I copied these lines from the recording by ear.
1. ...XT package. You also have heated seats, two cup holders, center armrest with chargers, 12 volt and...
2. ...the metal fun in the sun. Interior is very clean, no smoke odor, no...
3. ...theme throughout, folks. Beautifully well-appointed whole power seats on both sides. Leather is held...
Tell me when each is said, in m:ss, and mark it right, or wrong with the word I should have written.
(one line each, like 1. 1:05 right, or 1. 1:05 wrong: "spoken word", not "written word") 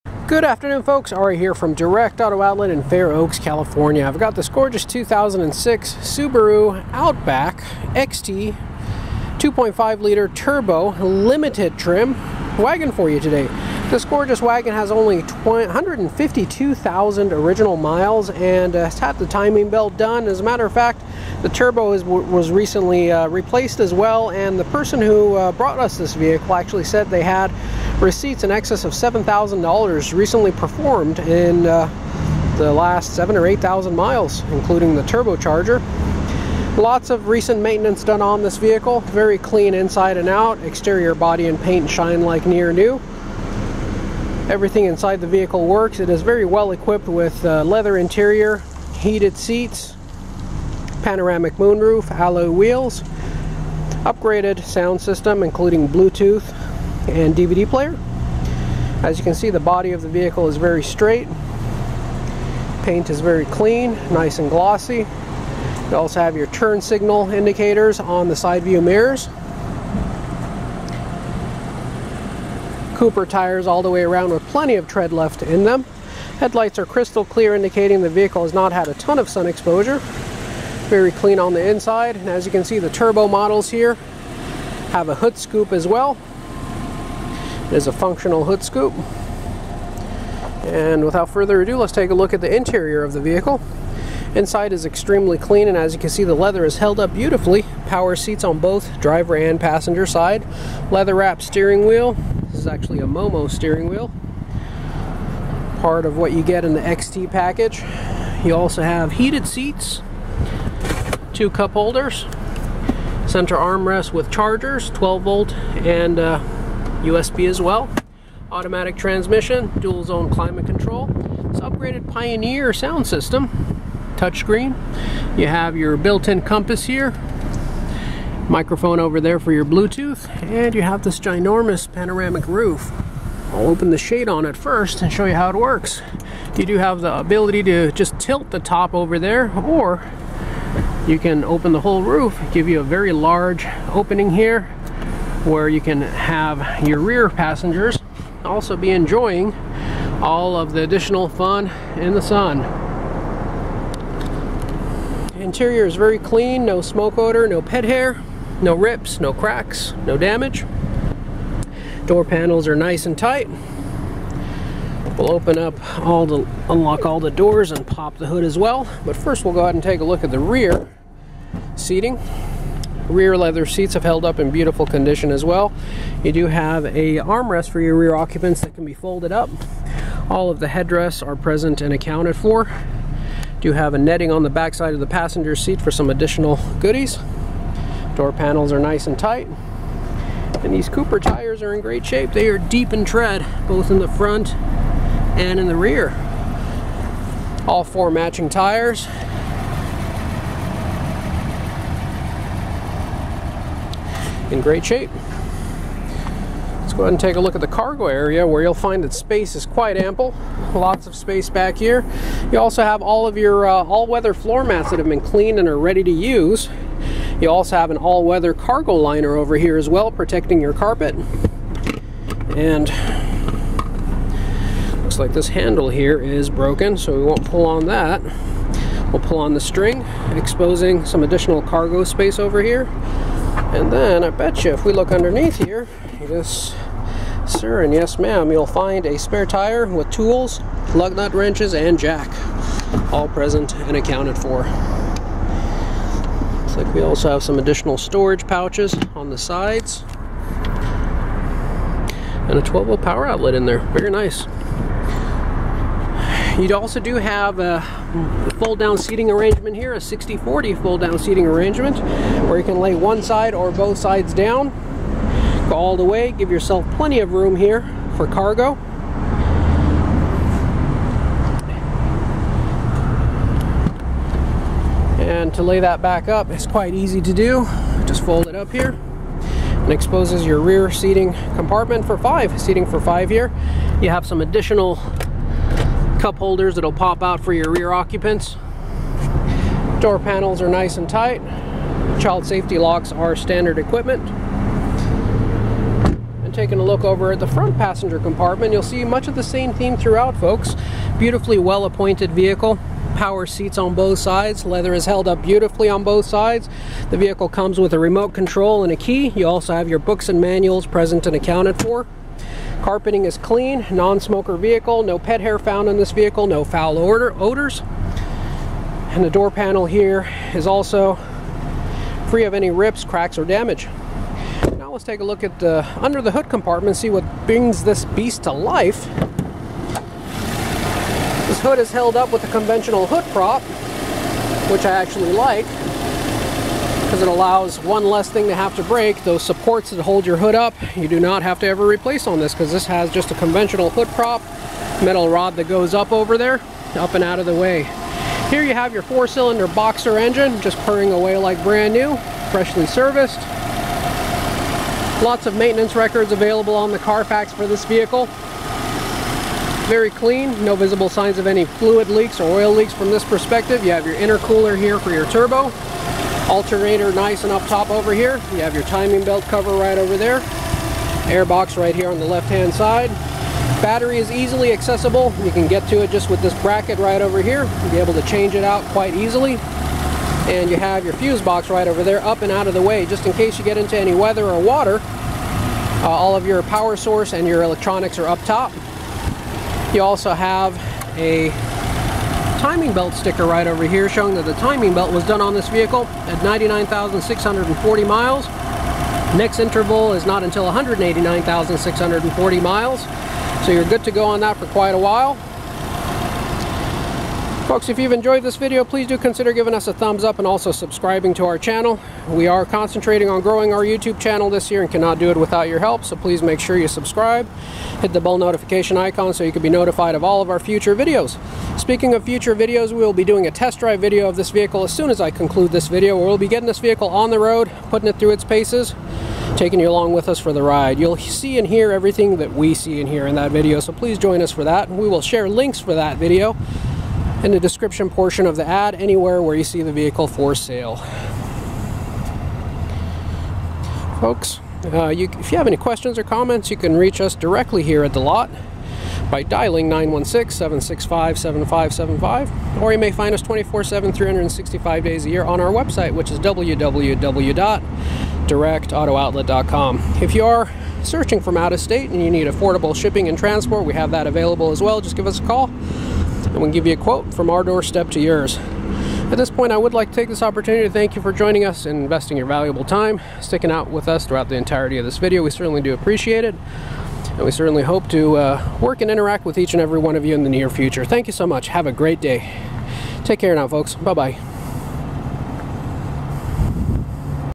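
1. 1:46 right
2. 2:30 wrong: "additional", not "metal"
3. 4:59 wrong: "vehicle", not "whole".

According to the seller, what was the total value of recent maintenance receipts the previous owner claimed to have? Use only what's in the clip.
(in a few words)
$7,000.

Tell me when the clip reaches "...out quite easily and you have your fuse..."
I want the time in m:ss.
6:18.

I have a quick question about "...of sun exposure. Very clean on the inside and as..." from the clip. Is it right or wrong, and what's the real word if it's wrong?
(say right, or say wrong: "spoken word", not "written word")
right.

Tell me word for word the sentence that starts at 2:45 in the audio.
We'll open up all the, unlock all the doors and pop the hood as well.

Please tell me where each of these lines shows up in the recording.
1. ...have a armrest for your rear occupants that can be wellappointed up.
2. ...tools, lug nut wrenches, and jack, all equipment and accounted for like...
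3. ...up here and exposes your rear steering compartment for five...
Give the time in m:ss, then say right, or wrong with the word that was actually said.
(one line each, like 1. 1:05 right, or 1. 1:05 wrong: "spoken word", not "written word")
1. 2:56 wrong: "folded", not "wellappointed"
2. 4:00 wrong: "present", not "equipment"
3. 4:38 wrong: "seating", not "steering".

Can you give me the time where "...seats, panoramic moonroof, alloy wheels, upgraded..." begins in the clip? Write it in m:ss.
0:49.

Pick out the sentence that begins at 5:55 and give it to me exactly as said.
Lots of maintenance records available on the Carfax for this vehicle.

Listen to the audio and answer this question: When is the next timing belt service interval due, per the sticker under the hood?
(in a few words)
189,640 miles.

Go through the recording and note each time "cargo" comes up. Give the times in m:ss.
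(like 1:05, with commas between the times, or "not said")
3:27, 3:38, 3:51, 4:28.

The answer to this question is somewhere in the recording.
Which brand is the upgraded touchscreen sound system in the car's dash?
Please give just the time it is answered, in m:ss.
2:02.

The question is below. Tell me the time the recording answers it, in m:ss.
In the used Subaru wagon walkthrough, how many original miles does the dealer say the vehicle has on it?
0:15.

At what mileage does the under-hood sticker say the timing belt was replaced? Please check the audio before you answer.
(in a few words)
99,640 miles.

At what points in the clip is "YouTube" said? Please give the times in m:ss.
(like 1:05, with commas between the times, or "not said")
6:53.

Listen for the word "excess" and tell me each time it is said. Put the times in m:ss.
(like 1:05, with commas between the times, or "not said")
0:28.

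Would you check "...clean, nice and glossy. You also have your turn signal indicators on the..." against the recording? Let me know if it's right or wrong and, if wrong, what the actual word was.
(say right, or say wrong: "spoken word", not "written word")
right.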